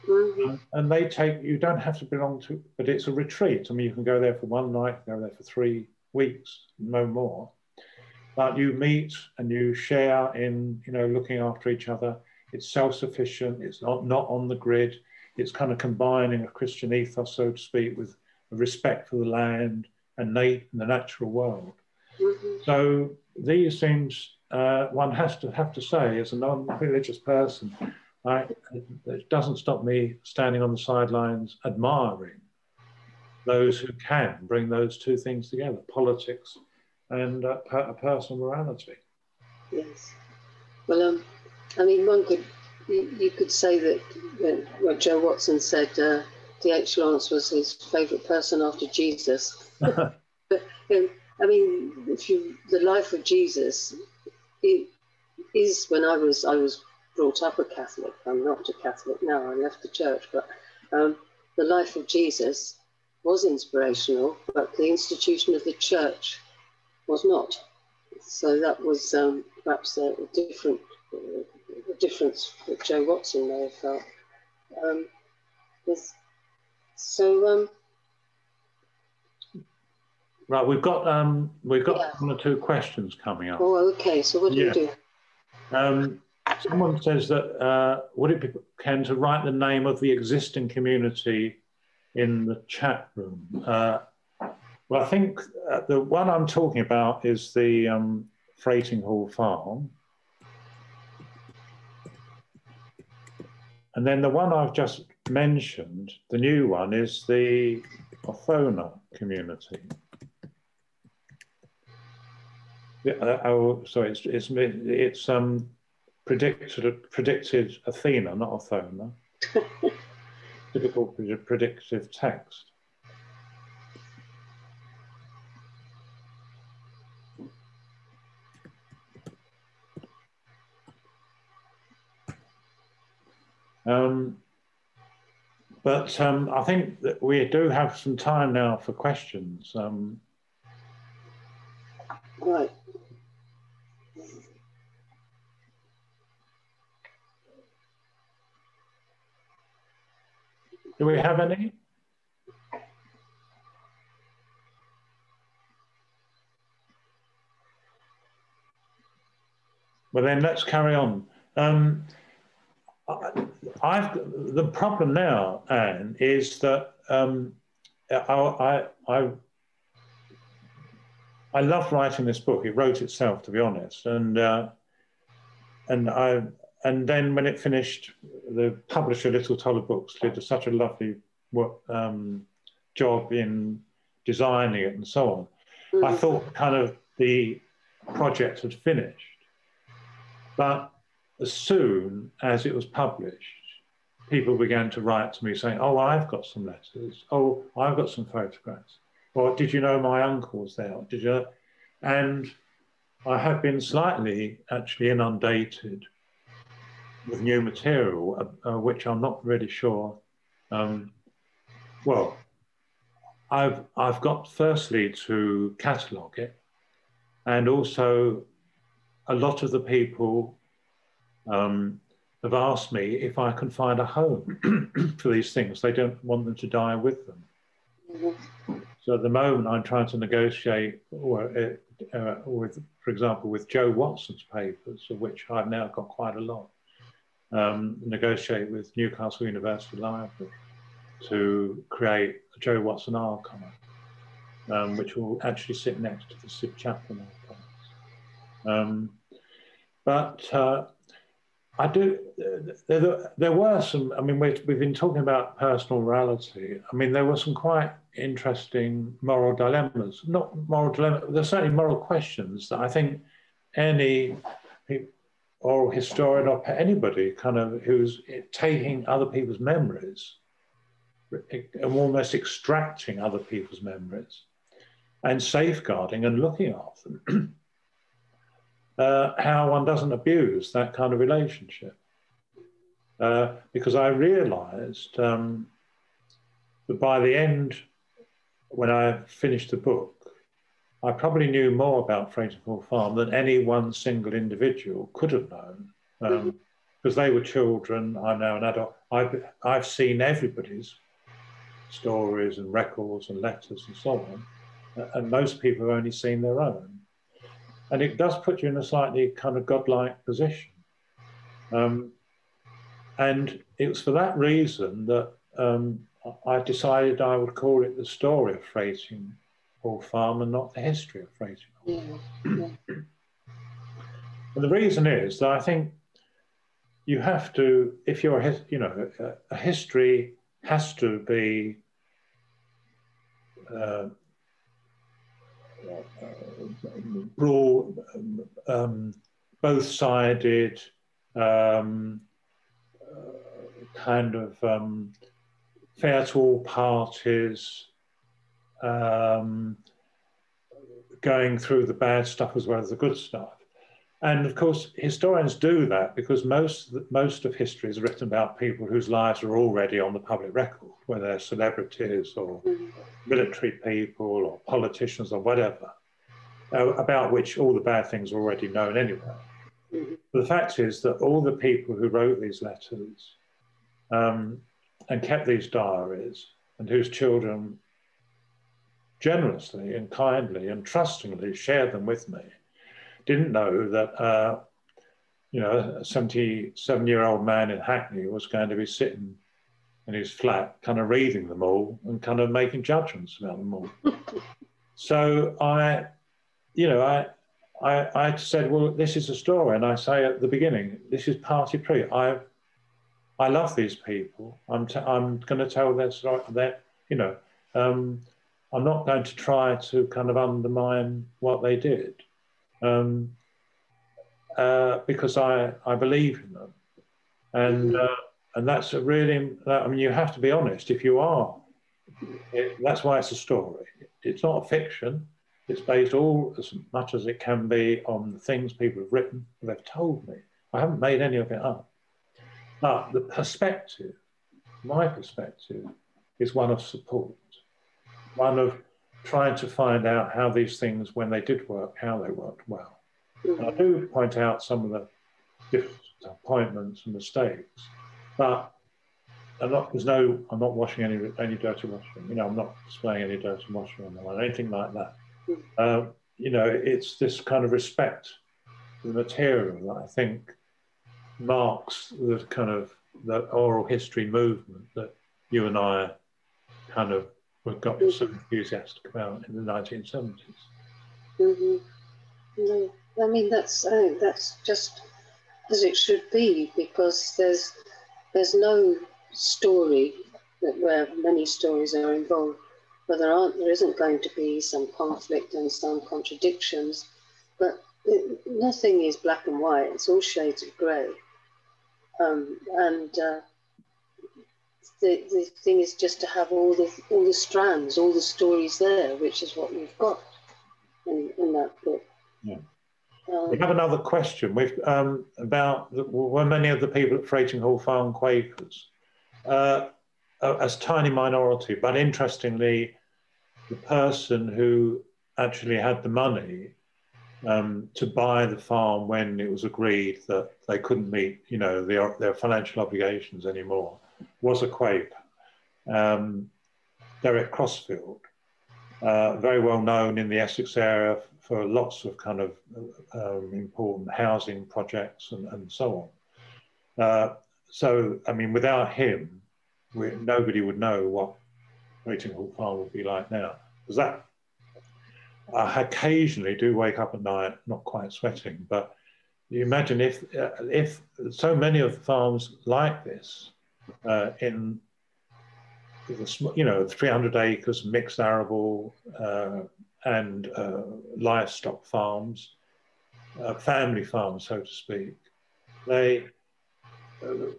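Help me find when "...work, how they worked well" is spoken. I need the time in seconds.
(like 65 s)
441 s.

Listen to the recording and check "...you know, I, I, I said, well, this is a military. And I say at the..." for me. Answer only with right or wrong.
wrong.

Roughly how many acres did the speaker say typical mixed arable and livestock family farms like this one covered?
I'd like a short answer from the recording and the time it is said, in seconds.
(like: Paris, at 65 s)
300, at 556 s.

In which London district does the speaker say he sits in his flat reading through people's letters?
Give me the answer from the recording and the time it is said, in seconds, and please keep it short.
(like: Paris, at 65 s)
Hackney, at 387 s.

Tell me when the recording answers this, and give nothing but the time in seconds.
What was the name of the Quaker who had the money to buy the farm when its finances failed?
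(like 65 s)
527 s.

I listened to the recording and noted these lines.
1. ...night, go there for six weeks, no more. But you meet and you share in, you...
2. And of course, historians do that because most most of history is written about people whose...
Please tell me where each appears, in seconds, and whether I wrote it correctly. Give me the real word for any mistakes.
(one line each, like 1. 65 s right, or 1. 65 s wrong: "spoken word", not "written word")
1. 4 s wrong: "three", not "six"
2. 354 s right.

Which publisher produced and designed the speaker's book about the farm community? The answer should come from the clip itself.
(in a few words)
Little Toller Books.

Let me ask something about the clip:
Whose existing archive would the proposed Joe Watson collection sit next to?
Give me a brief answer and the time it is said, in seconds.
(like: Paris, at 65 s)
Sid Chaplin, at 246 s.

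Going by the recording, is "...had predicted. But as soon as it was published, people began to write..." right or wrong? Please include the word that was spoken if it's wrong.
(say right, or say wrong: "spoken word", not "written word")
wrong: "finished", not "predicted".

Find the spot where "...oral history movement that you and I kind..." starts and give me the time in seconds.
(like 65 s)
463 s.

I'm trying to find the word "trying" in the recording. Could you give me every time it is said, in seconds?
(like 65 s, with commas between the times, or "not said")
229 s, 439 s.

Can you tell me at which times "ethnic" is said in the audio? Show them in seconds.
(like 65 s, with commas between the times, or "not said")
not said.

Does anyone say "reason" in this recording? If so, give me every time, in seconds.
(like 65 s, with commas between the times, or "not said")
314 s, 324 s.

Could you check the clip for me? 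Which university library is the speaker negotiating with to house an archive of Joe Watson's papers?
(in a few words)
Newcastle University Library.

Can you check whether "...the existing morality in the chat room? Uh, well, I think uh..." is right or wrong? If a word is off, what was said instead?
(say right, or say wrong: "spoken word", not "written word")
wrong: "community", not "morality".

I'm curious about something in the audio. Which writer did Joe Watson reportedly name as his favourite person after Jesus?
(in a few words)
D.H. Lawrence.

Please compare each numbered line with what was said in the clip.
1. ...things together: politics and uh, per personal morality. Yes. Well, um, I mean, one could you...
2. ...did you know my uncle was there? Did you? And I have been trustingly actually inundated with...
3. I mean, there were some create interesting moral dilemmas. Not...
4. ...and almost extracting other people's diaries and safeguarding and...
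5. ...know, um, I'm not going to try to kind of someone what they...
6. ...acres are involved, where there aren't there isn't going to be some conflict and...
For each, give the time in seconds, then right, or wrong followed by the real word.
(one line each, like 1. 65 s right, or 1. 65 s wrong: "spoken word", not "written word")
1. 35 s right
2. 199 s wrong: "slightly", not "trustingly"
3. 256 s wrong: "quite", not "create"
4. 271 s wrong: "memories", not "diaries"
5. 407 s wrong: "undermine", not "someone"
6. 481 s wrong: "stories", not "acres".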